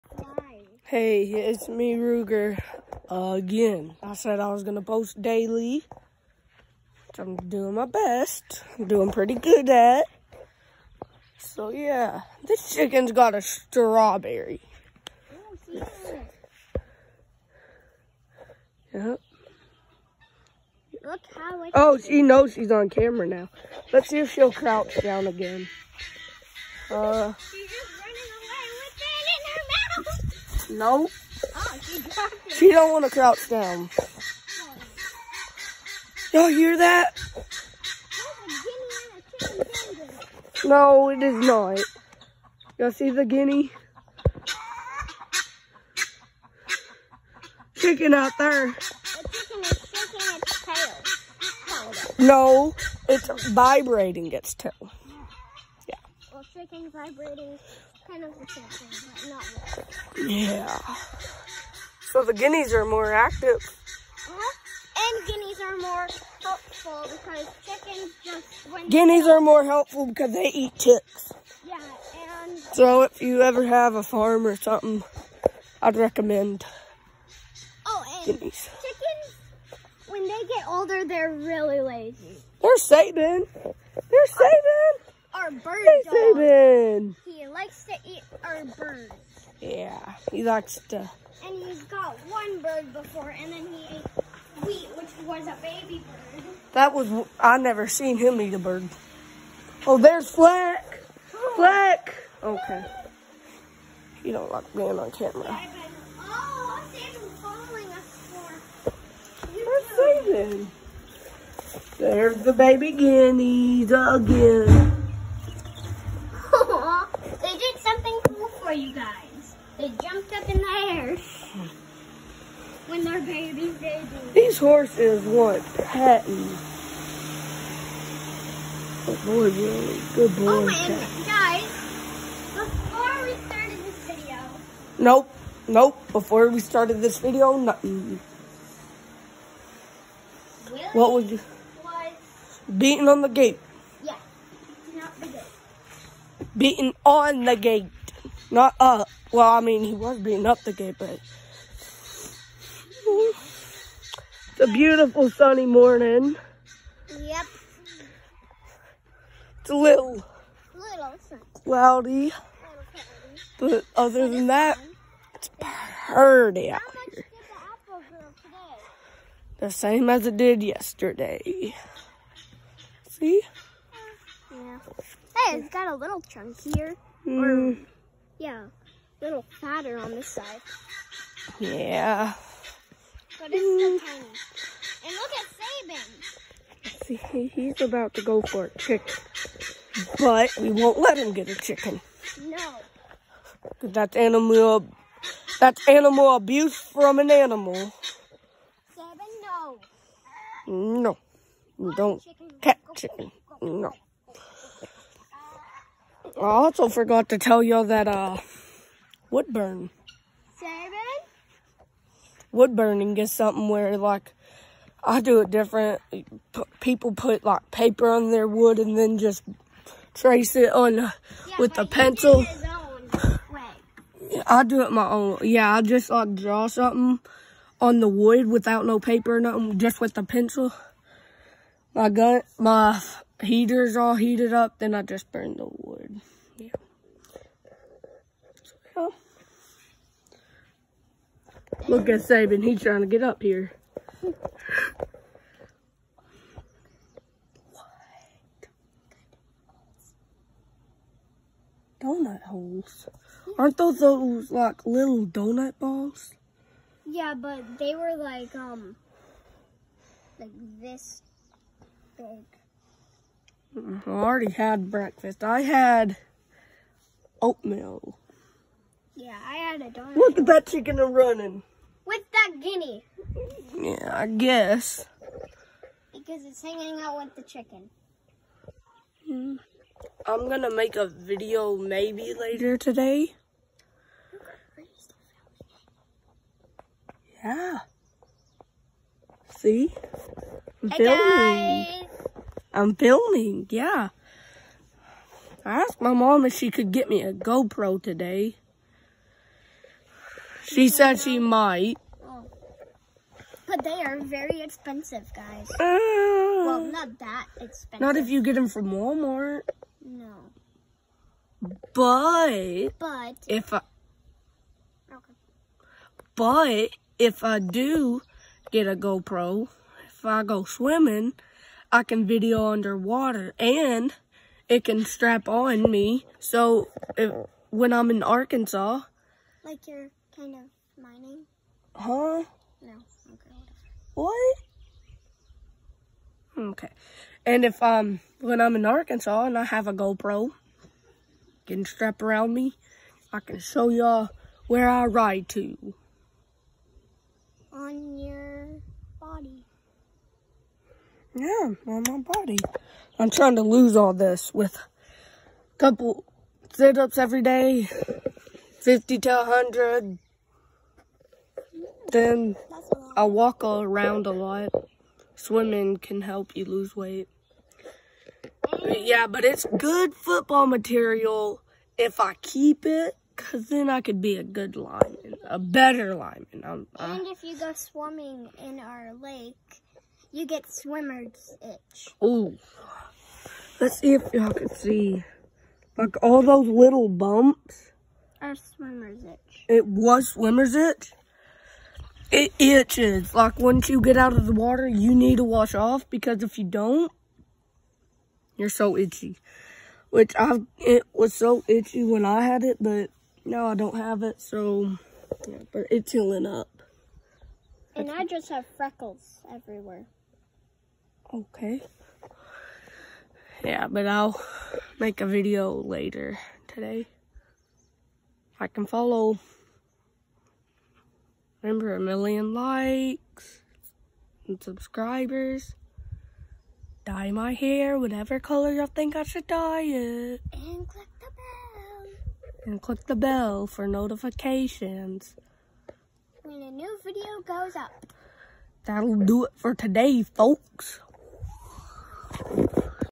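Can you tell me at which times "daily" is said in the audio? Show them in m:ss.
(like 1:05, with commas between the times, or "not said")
0:05.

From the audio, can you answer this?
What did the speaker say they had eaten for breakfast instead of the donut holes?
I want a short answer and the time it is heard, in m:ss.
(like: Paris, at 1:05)
oatmeal, at 4:27.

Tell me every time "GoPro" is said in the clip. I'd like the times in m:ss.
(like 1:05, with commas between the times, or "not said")
4:57, 5:18, 5:39.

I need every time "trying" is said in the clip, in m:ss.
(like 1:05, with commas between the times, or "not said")
4:02, 5:53.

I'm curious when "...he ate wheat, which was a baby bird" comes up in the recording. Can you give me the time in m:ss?
1:33.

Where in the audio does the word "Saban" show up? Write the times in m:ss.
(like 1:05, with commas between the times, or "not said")
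4:02.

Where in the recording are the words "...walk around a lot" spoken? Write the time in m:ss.
6:03.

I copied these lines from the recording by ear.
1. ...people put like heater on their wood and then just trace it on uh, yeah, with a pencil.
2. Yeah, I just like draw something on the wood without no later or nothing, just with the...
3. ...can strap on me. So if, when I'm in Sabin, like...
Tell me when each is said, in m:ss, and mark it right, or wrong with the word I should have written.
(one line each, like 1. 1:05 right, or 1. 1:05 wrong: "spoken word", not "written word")
1. 3:36 wrong: "paper", not "heater"
2. 3:45 wrong: "paper", not "later"
3. 5:24 wrong: "Arkansas", not "Sabin".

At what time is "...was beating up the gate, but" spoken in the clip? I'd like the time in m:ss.
2:29.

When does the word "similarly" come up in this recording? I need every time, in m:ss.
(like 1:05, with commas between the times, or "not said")
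not said.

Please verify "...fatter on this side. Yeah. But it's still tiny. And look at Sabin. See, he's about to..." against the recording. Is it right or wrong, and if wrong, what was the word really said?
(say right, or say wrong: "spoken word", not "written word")
right.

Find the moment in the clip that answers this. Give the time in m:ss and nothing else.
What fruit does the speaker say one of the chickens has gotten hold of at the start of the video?
0:13.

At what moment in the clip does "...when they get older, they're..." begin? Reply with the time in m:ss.
1:20.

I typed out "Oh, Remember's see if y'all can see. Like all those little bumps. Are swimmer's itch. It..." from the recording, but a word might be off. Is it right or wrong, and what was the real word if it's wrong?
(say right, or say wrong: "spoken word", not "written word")
wrong: "Let", not "Remember".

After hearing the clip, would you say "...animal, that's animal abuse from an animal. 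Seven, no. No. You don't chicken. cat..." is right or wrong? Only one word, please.
right.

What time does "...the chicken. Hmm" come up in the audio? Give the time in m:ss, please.
4:37.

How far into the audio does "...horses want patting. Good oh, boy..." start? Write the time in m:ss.
2:04.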